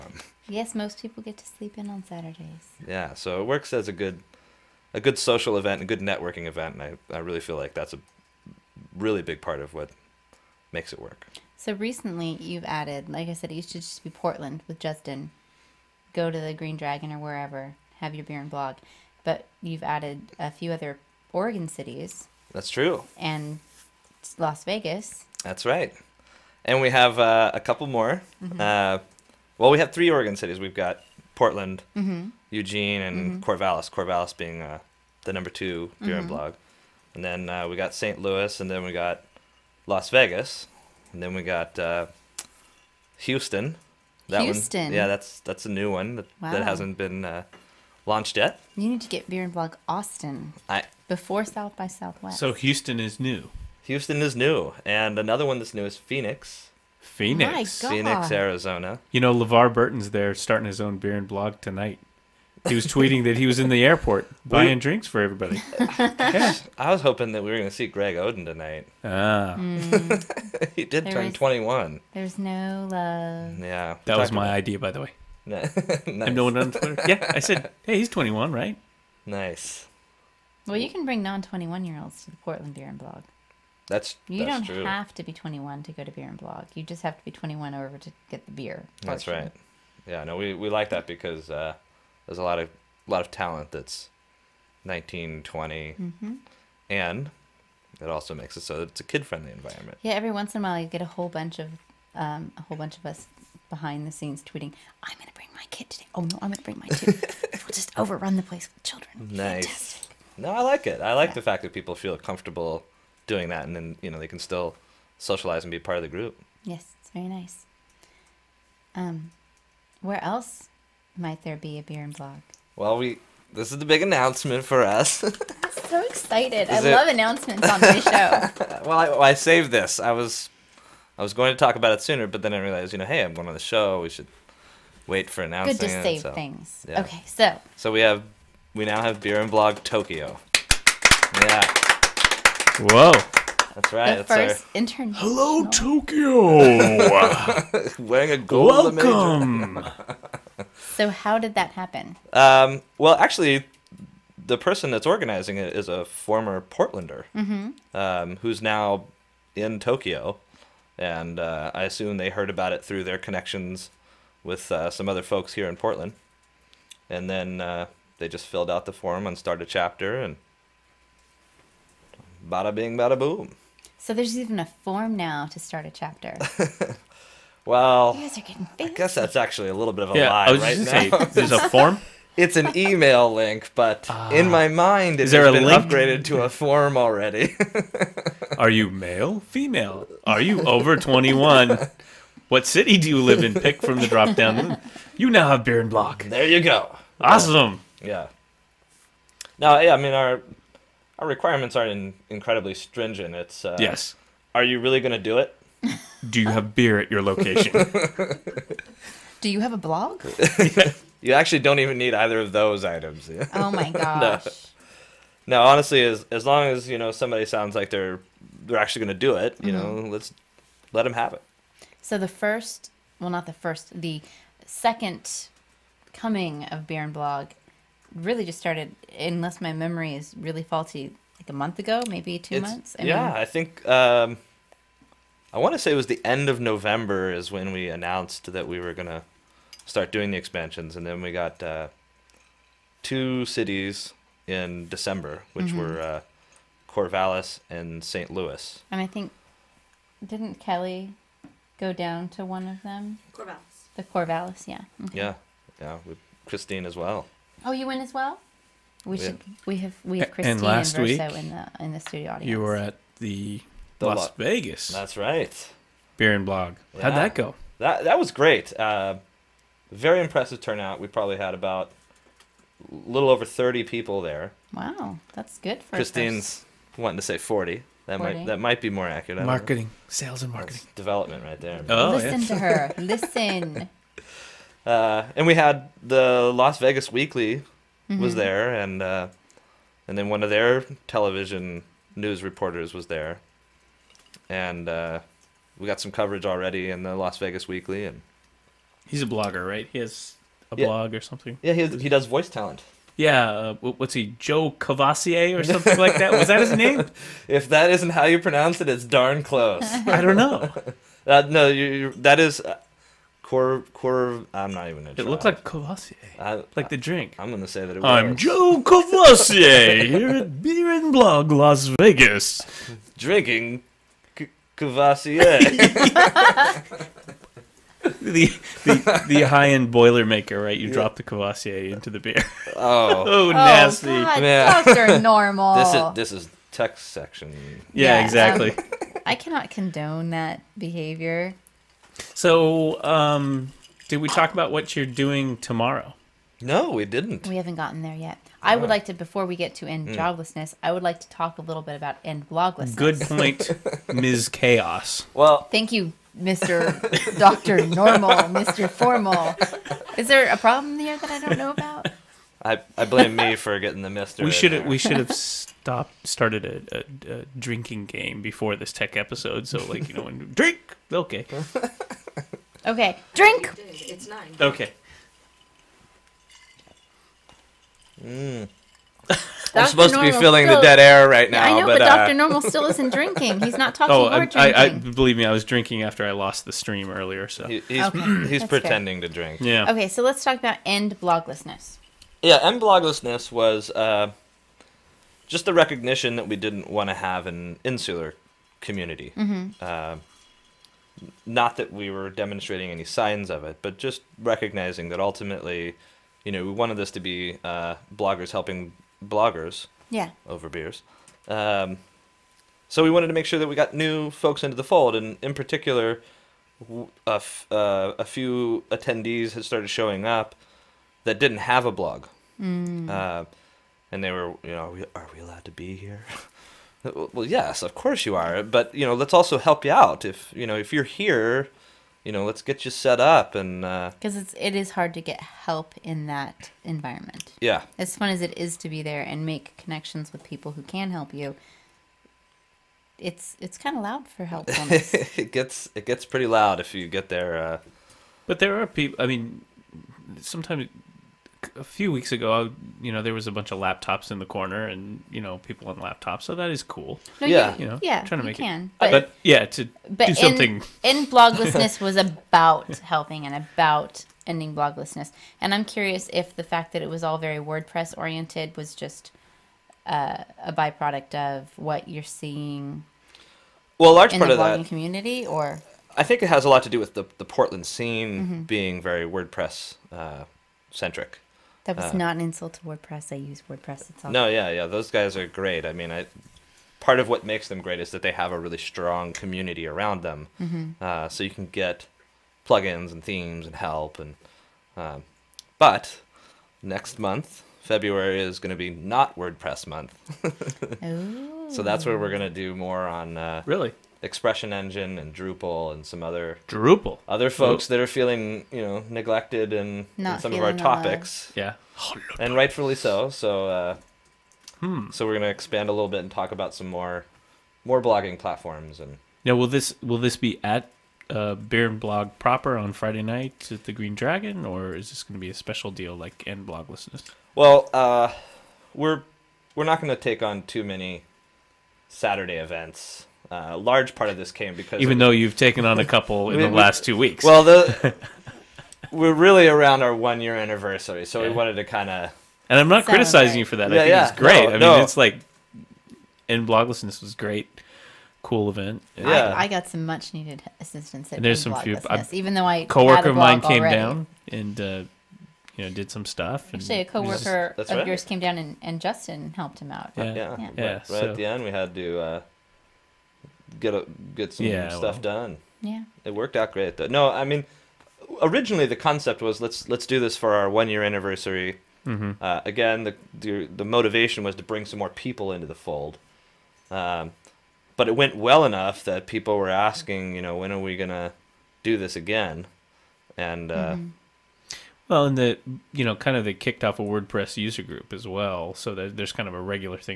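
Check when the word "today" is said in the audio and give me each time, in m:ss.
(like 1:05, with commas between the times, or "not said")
1:45.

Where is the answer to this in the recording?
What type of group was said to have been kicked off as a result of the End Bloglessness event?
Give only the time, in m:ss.
9:47.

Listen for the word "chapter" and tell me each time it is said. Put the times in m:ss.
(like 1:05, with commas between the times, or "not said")
2:49, 2:55.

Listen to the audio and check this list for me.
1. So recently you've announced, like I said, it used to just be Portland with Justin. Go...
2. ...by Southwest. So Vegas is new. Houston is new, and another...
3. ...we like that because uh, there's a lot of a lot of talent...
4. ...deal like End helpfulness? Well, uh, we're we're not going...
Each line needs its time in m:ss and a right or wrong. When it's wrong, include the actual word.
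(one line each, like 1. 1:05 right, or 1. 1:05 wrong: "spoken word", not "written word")
1. 0:11 wrong: "added", not "announced"
2. 0:51 wrong: "Houston", not "Vegas"
3. 1:30 right
4. 8:45 wrong: "bloglessness", not "helpfulness".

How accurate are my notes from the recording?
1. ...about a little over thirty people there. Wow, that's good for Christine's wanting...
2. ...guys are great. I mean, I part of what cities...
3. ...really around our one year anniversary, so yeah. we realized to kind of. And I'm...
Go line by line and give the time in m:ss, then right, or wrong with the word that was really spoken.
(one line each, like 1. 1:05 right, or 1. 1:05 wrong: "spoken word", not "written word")
1. 4:31 right
2. 8:05 wrong: "makes", not "cities"
3. 8:59 wrong: "wanted", not "realized".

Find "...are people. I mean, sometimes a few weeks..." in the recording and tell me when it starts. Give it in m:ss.
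7:28.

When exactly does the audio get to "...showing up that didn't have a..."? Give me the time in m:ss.
6:59.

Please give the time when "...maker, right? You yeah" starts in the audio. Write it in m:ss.
5:30.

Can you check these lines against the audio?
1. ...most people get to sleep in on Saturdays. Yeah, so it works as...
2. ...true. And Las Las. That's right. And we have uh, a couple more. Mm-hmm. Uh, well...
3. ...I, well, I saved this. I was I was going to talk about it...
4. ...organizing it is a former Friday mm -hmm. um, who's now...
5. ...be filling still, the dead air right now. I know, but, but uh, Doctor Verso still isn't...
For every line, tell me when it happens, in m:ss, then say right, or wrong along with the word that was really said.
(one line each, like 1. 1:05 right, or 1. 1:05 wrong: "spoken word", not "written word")
1. 0:00 right
2. 0:22 wrong: "Vegas", not "Las"
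3. 2:08 right
4. 2:35 wrong: "Portlander", not "Friday"
5. 6:20 wrong: "Normal", not "Verso".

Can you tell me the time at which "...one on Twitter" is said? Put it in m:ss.
1:16.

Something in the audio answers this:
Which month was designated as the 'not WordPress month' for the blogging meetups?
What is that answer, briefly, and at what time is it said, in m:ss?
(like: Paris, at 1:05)
February, at 8:17.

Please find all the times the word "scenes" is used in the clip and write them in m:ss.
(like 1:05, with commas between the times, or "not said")
1:44, 7:57.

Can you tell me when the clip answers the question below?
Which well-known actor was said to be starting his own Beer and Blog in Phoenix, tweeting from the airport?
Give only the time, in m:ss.
0:59.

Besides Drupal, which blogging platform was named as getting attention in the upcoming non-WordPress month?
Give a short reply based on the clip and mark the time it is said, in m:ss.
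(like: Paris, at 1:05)
Expression Engine, at 8:24.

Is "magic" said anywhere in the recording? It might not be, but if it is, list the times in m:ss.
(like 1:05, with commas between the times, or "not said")
not said.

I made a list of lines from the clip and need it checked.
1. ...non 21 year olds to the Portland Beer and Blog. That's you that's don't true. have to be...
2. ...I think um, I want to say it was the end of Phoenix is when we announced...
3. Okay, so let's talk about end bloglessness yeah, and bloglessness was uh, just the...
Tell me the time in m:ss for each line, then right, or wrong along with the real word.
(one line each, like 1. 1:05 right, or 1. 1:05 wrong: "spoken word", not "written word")
1. 1:21 right
2. 3:53 wrong: "November", not "Phoenix"
3. 6:29 right.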